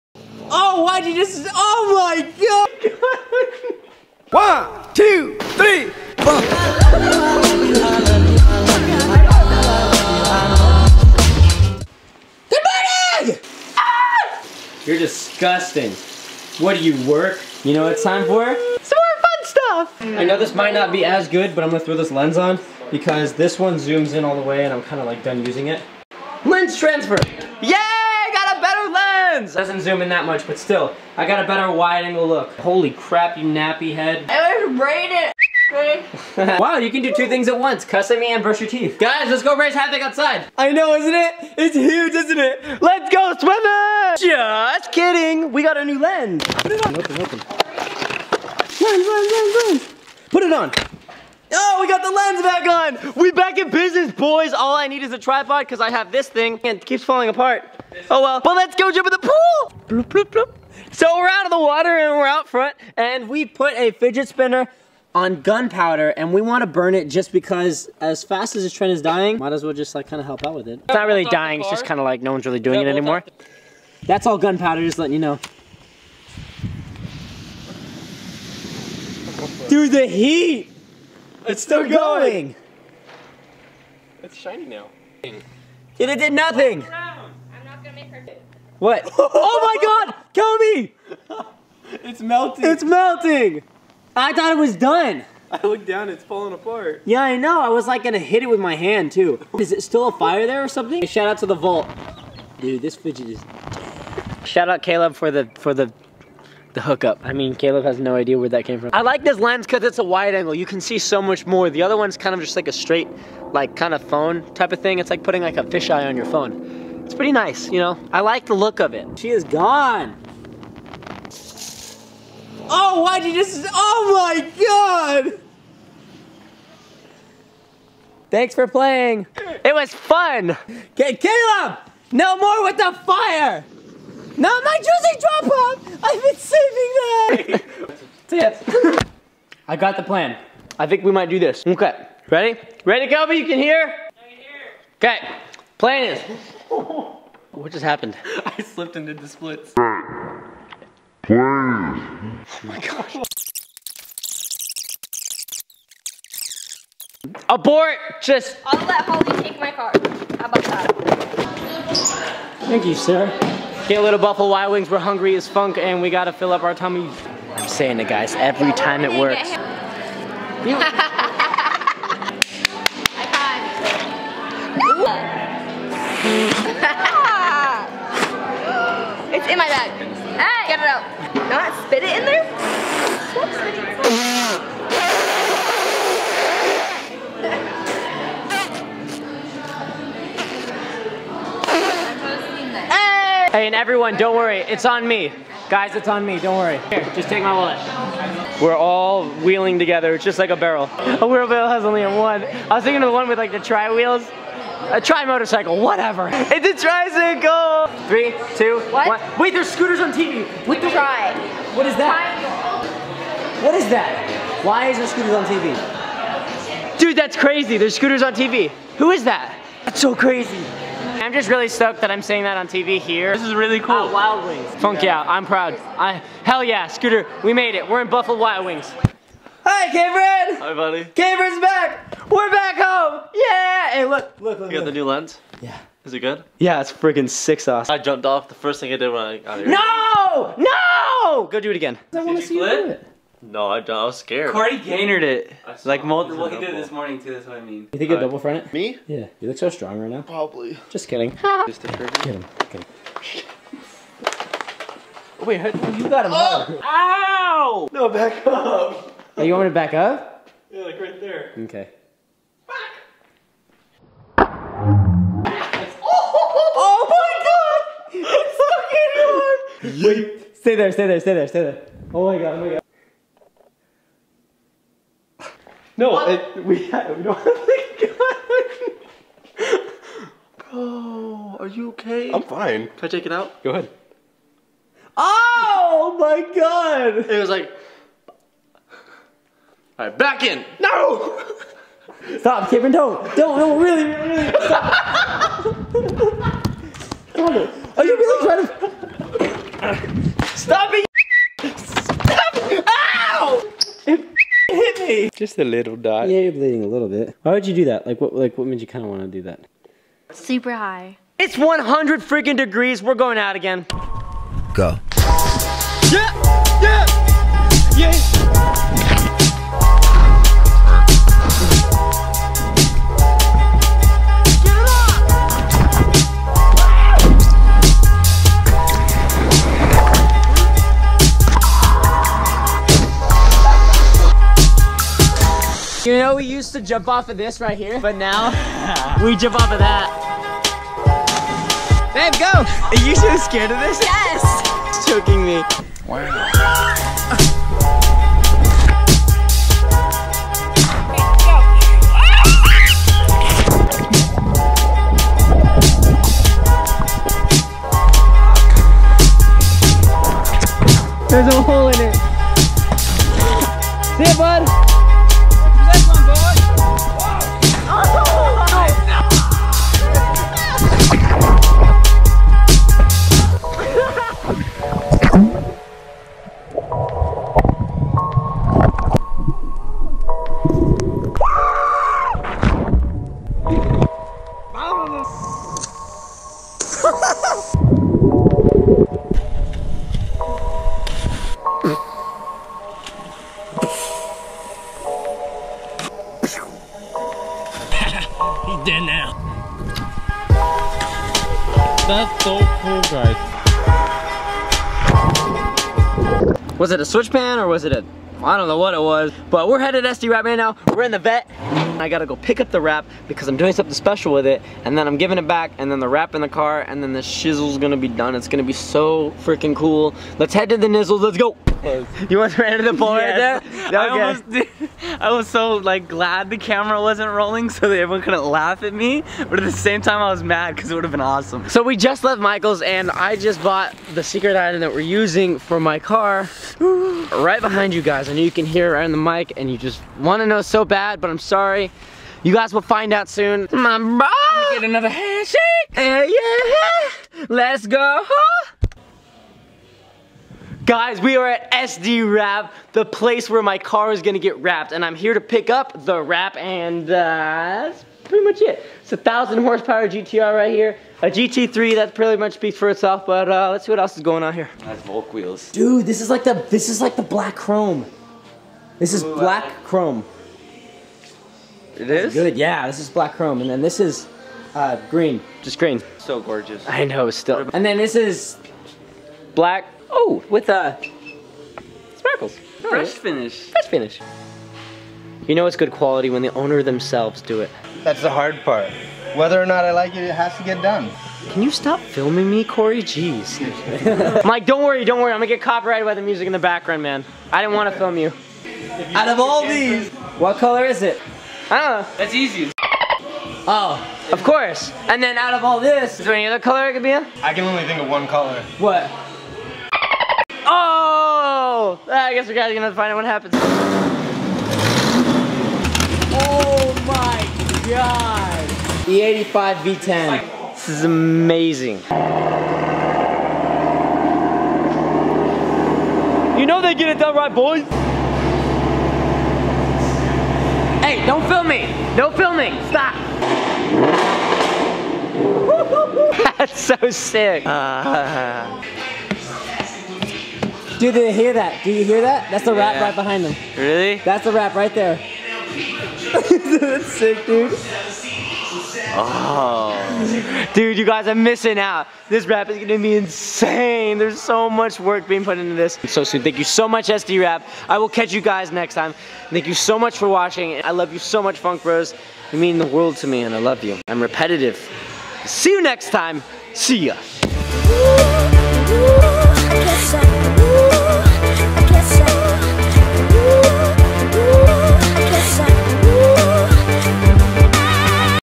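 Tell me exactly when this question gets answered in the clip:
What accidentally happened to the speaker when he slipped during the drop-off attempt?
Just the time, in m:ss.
2:29.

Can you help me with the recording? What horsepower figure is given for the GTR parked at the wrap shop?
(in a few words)
1,000.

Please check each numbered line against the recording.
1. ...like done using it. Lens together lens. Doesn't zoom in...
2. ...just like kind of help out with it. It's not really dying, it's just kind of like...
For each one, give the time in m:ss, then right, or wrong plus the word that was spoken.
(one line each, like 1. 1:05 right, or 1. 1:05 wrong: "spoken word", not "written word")
1. 0:25 wrong: "transfer", not "together"
2. 1:09 right.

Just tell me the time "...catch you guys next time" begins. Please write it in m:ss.
9:18.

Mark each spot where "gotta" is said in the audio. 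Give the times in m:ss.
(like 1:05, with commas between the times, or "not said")
2:46, 6:52.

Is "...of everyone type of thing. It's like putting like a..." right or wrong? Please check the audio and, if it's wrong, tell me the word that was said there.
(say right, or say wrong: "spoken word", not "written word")
wrong: "phone", not "everyone".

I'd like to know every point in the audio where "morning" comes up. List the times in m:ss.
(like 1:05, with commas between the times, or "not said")
0:12, 4:06.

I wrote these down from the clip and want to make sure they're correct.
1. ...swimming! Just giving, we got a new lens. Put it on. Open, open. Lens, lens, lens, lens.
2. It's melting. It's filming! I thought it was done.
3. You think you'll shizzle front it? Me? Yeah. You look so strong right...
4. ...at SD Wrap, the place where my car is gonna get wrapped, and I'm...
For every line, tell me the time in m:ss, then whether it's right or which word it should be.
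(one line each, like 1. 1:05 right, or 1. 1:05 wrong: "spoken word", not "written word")
1. 0:43 wrong: "kidding", not "giving"
2. 1:32 wrong: "melting", not "filming"
3. 4:07 wrong: "double", not "shizzle"
4. 7:31 right.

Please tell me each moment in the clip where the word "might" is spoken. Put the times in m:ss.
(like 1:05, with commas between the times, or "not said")
0:20, 1:09, 2:21.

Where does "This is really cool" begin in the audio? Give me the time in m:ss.
3:43.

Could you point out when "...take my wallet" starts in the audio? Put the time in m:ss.
3:17.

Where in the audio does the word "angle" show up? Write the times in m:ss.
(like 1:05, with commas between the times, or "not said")
0:32, 1:50.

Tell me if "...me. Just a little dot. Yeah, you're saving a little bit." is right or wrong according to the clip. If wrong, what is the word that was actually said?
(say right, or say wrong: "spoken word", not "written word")
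wrong: "bleeding", not "saving".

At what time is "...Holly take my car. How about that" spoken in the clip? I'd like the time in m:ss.
2:39.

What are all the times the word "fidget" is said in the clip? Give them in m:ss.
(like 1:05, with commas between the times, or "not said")
1:03, 1:42.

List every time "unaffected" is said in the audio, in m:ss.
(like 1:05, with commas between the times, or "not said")
not said.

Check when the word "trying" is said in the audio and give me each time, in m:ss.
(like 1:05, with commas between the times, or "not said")
4:58.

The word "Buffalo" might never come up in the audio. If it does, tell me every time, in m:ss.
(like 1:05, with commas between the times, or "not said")
2:44, 3:48.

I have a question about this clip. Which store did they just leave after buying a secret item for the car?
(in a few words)
Michael's.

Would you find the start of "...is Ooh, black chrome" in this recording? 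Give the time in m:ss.
7:49.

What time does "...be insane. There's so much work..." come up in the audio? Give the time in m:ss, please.
9:12.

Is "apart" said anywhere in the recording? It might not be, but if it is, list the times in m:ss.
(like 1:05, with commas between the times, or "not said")
0:57, 1:36.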